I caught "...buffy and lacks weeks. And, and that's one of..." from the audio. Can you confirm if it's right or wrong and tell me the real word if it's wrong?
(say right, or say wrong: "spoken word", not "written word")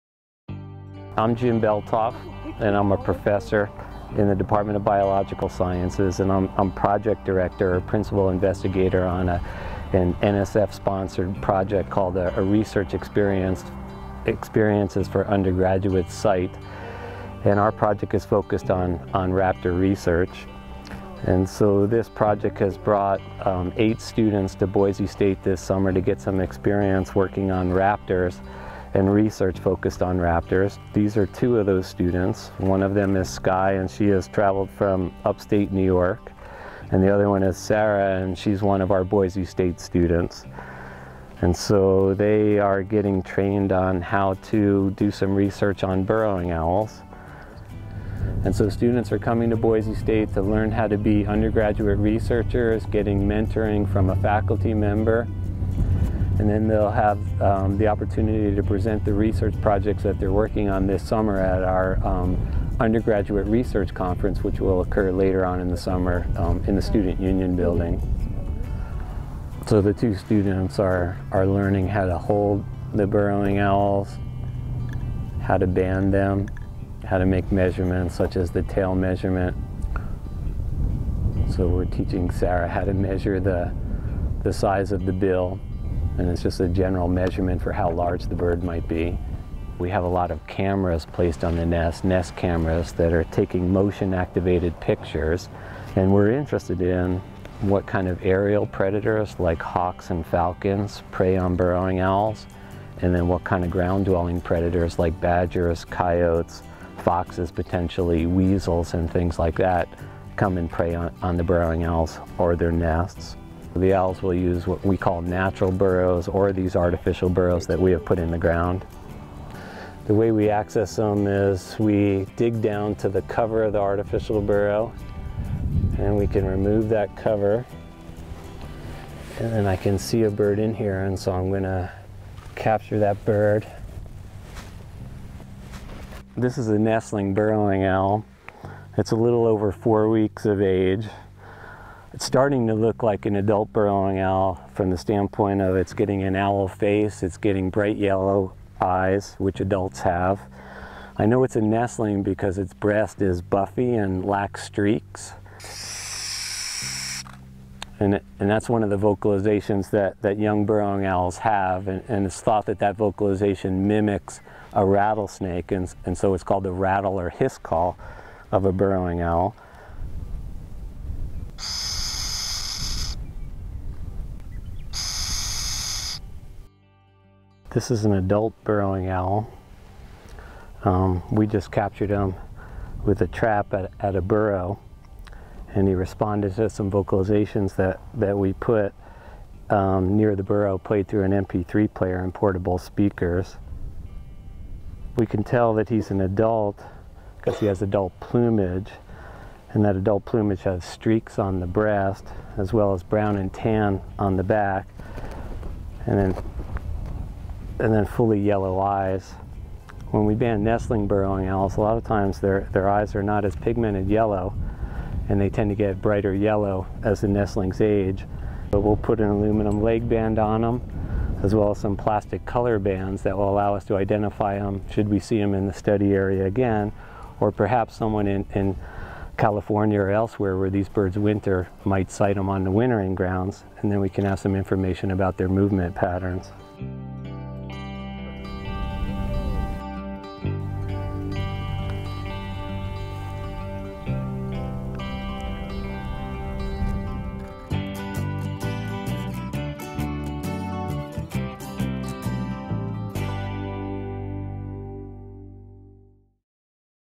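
wrong: "streaks", not "weeks".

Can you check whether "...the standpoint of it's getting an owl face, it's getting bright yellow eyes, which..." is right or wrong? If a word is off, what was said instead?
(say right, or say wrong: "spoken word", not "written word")
right.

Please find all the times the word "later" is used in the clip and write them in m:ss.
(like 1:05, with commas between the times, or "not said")
1:05.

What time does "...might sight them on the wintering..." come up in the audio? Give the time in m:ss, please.
3:51.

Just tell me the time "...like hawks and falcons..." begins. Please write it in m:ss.
1:39.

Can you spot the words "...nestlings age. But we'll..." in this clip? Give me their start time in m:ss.
3:37.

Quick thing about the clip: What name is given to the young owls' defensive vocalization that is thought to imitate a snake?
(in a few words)
rattle or hiss call.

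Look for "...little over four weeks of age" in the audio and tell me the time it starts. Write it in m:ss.
2:19.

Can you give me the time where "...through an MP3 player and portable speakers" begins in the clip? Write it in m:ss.
3:11.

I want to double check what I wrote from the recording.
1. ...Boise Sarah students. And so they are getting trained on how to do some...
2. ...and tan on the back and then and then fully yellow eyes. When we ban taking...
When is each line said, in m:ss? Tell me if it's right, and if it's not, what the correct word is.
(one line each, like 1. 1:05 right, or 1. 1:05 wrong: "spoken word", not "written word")
1. 0:39 wrong: "State", not "Sarah"
2. 3:23 wrong: "nestling", not "taking".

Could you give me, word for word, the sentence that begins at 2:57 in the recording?
This is an adult burrowing owl.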